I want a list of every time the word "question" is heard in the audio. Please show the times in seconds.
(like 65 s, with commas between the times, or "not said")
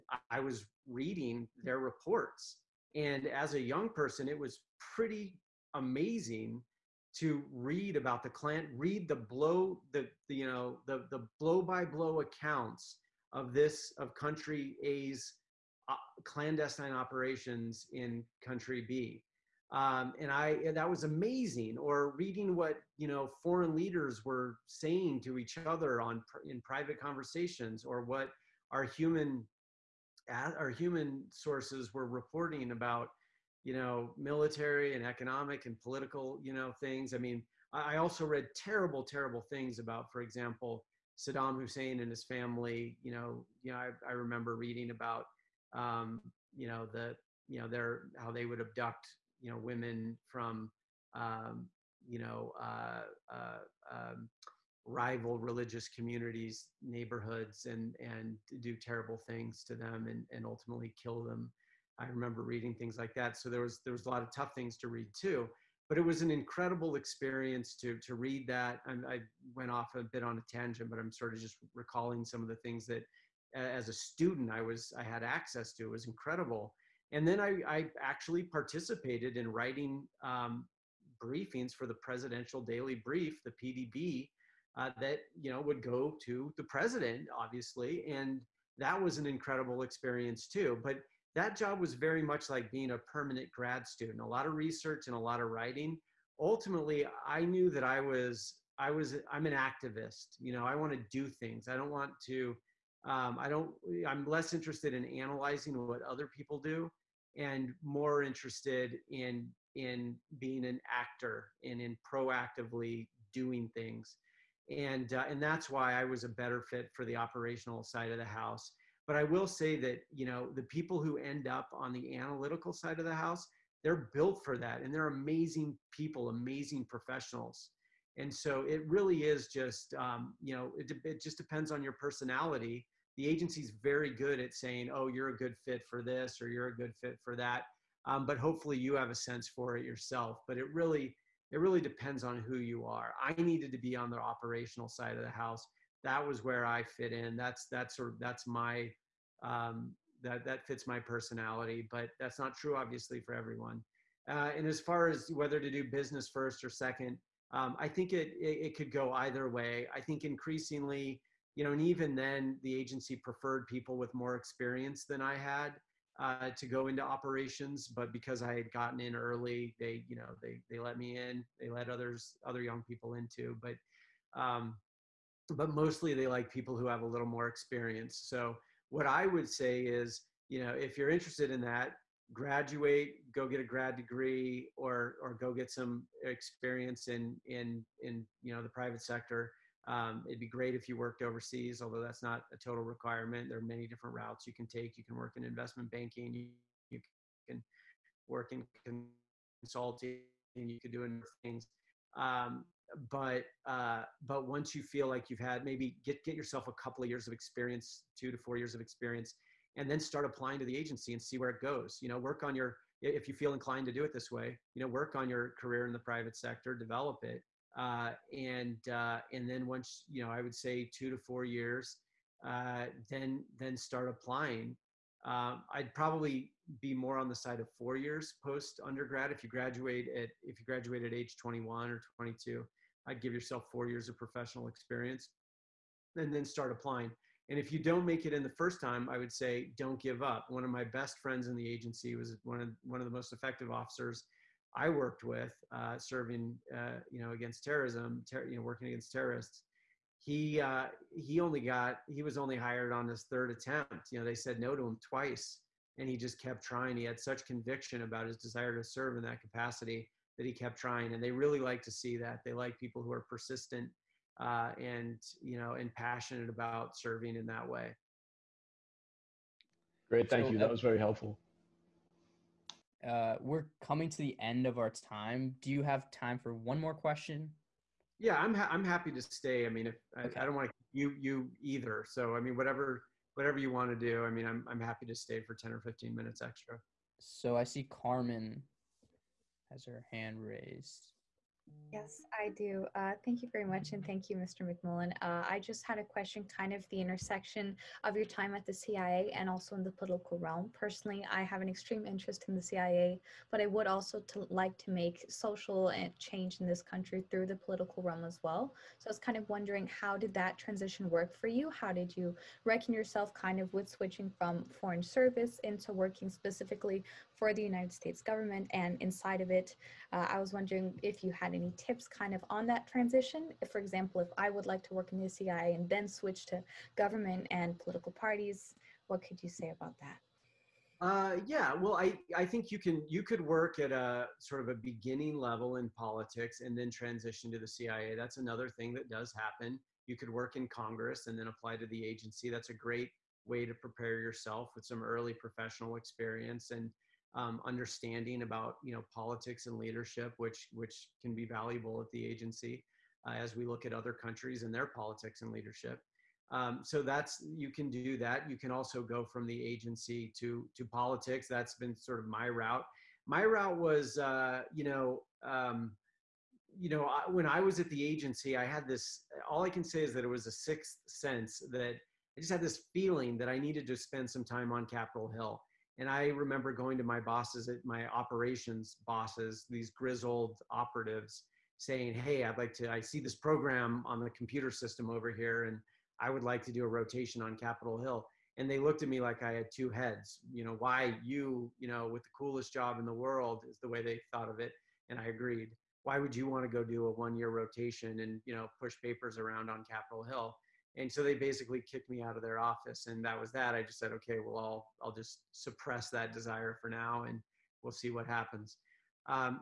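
276 s, 296 s.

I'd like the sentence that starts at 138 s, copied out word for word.
Um, but hopefully you have a sense for it yourself.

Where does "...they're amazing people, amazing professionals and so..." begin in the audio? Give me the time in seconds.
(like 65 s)
124 s.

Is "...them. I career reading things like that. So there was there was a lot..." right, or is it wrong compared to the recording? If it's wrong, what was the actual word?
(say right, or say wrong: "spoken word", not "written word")
wrong: "remember", not "career".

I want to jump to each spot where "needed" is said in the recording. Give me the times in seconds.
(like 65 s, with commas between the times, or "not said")
143 s, 373 s.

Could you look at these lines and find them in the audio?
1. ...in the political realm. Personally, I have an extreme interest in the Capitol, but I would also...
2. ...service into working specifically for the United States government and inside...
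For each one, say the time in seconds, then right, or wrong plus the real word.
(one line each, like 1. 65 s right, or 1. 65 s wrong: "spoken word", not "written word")
1. 299 s wrong: "CIA", not "Capitol"
2. 315 s right.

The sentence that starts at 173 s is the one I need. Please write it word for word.
But um, but mostly they like people who have a little more experience.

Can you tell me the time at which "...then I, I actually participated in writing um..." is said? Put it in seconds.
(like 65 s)
77 s.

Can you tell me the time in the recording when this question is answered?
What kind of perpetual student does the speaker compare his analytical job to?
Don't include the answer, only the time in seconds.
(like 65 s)
92 s.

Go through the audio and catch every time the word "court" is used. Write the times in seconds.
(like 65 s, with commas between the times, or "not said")
not said.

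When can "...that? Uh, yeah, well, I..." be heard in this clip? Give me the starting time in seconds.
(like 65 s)
330 s.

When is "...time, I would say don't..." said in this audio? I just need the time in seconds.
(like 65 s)
238 s.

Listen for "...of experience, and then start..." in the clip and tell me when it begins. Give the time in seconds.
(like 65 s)
208 s.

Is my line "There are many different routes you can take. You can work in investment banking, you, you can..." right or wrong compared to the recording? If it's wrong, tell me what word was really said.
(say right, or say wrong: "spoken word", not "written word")
right.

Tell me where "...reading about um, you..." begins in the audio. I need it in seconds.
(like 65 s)
44 s.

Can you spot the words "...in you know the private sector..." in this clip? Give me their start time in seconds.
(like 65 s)
188 s.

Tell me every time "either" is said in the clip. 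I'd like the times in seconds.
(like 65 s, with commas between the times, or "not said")
159 s, 281 s.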